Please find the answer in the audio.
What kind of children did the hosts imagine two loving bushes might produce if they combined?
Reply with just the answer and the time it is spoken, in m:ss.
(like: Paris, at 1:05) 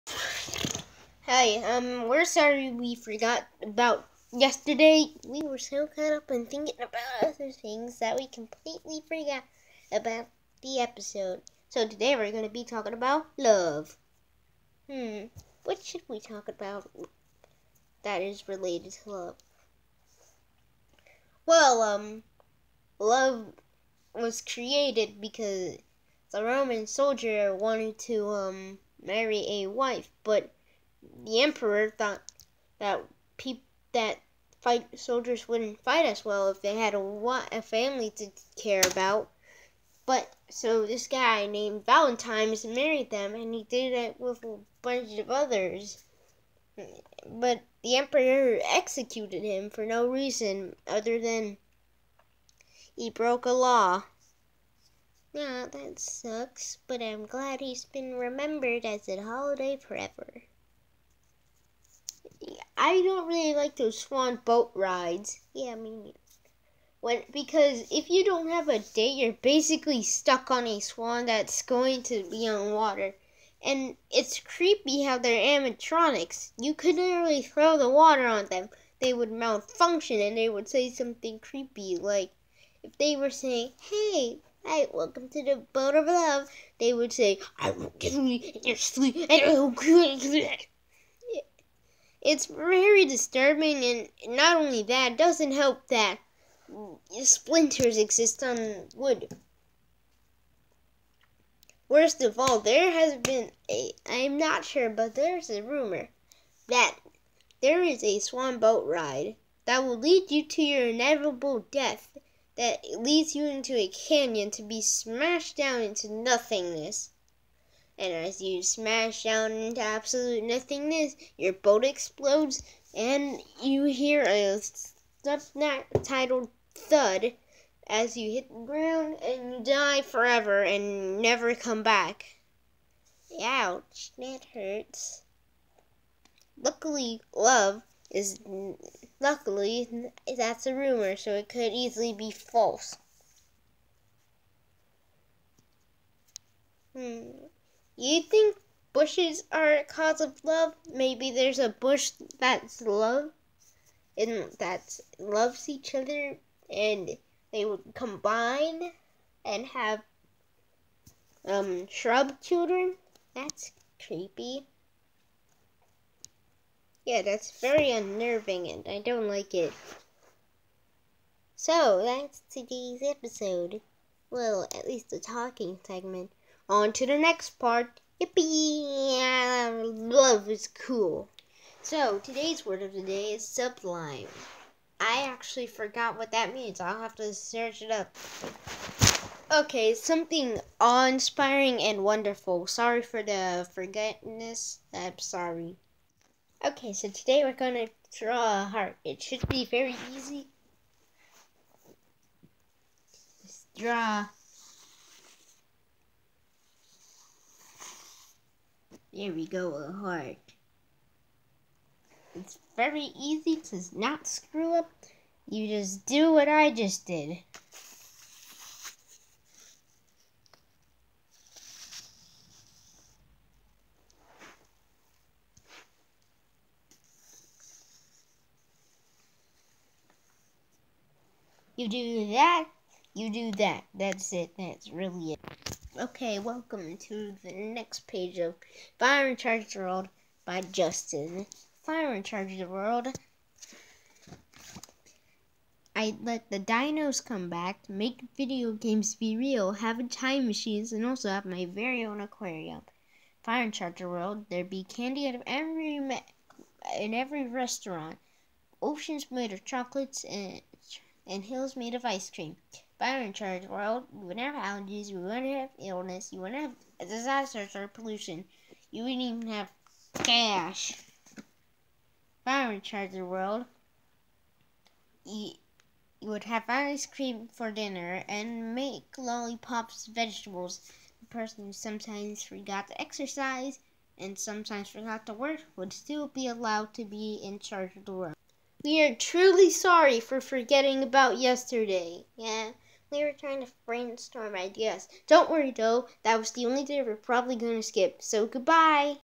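shrub children, at 2:41.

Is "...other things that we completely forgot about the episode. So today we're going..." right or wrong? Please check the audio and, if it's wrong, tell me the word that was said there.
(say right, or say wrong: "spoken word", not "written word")
right.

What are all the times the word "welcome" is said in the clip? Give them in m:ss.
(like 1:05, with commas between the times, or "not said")
1:24, 3:56.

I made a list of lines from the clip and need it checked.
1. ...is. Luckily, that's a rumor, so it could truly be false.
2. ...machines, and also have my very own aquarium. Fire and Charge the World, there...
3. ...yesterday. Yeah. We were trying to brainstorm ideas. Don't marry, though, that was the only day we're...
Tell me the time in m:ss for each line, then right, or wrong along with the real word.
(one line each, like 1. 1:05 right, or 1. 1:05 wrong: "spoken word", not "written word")
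1. 2:18 wrong: "easily", not "truly"
2. 4:10 right
3. 4:51 wrong: "worry", not "marry".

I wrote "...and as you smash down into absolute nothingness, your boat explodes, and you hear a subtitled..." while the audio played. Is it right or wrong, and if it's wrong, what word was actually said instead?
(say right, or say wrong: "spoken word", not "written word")
right.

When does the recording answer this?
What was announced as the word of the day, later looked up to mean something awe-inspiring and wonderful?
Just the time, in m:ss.
3:03.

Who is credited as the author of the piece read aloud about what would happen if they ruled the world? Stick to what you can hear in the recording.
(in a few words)
Justin.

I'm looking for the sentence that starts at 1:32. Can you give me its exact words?
It's very disturbing, and not only that, doesn't help that splinters exist on wood.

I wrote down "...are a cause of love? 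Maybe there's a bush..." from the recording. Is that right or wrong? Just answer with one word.
right.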